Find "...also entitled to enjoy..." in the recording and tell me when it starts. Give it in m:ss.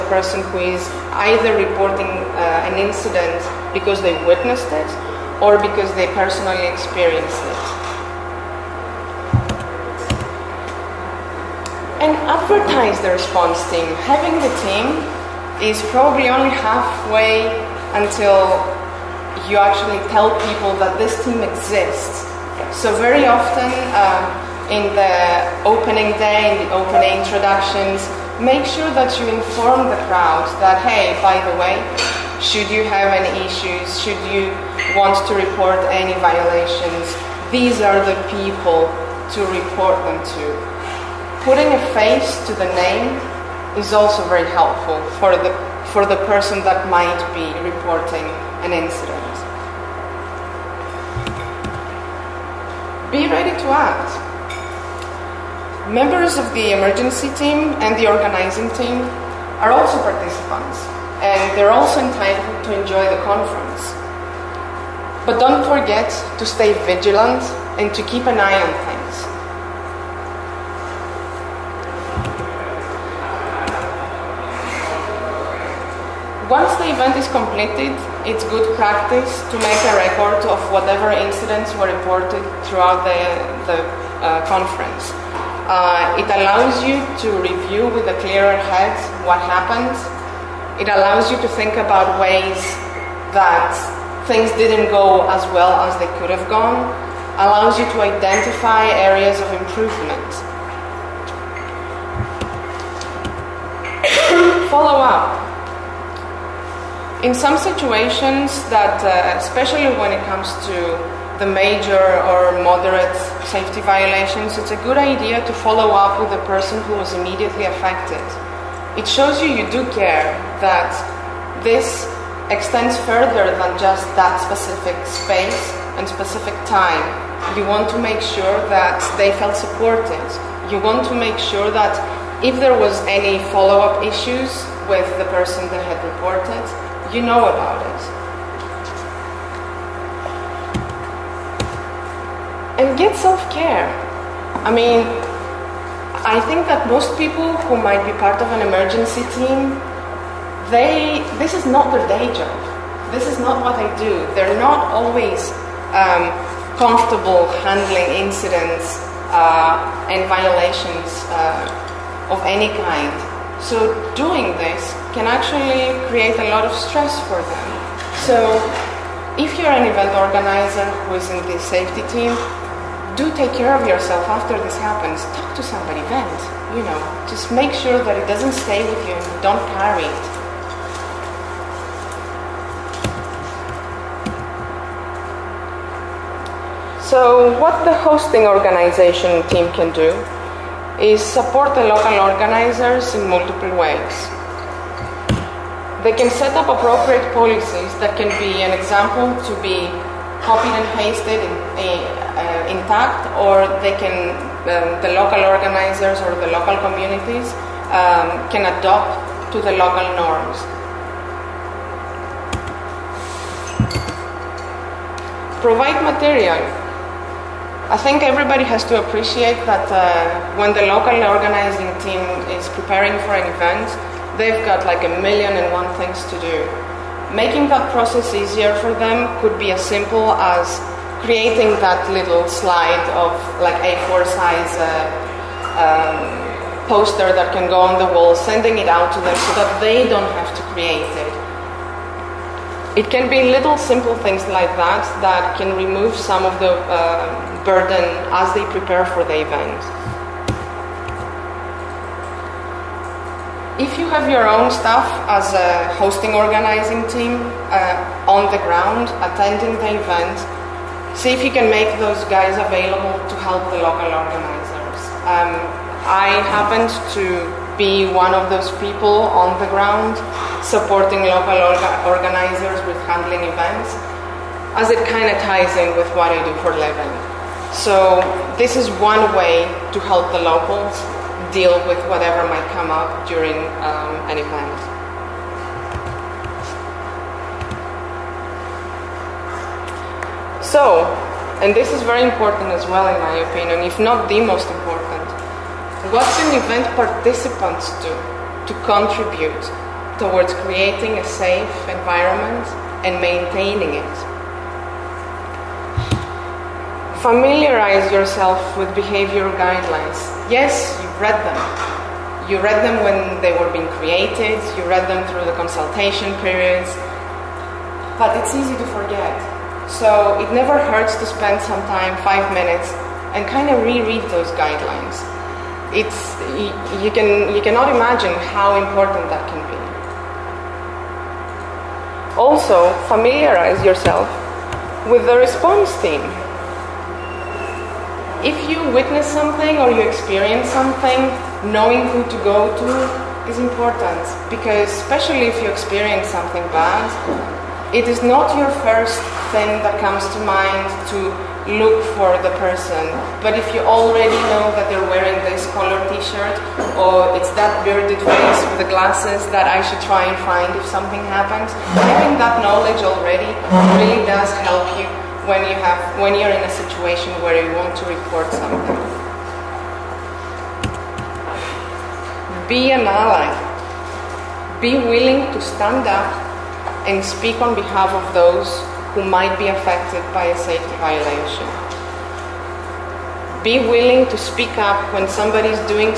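1:01.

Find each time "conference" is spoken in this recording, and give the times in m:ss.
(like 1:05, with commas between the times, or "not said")
1:03, 1:24.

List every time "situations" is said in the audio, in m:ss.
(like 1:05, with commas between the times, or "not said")
1:47, 6:06.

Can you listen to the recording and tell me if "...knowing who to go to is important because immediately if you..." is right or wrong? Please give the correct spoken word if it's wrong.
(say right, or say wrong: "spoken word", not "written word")
wrong: "especially", not "immediately".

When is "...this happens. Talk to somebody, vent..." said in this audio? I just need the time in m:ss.
2:54.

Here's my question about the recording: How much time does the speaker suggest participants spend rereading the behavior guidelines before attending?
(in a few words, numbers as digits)
5 minutes.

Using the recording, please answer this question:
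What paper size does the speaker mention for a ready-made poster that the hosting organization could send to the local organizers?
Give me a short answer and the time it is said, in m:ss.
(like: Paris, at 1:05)
A4, at 3:53.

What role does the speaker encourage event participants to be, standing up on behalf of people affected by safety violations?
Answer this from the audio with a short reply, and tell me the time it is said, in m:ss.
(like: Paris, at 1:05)
An ally, at 6:13.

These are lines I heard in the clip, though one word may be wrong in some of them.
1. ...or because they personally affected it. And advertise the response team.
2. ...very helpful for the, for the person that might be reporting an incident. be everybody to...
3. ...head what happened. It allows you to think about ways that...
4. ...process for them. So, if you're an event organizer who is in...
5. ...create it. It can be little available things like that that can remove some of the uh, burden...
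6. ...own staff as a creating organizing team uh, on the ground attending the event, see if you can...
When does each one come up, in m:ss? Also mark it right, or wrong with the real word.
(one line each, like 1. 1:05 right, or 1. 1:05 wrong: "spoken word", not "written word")
1. 0:05 wrong: "experienced", not "affected"
2. 0:44 wrong: "ready", not "everybody"
3. 1:28 right
4. 2:46 wrong: "stress", not "process"
5. 4:00 wrong: "simple", not "available"
6. 4:14 wrong: "hosting", not "creating".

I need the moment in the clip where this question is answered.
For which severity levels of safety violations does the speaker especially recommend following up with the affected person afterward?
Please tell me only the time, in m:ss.
1:51.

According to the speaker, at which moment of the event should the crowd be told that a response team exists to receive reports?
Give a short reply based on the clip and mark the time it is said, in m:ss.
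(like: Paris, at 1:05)
Opening day, at 0:25.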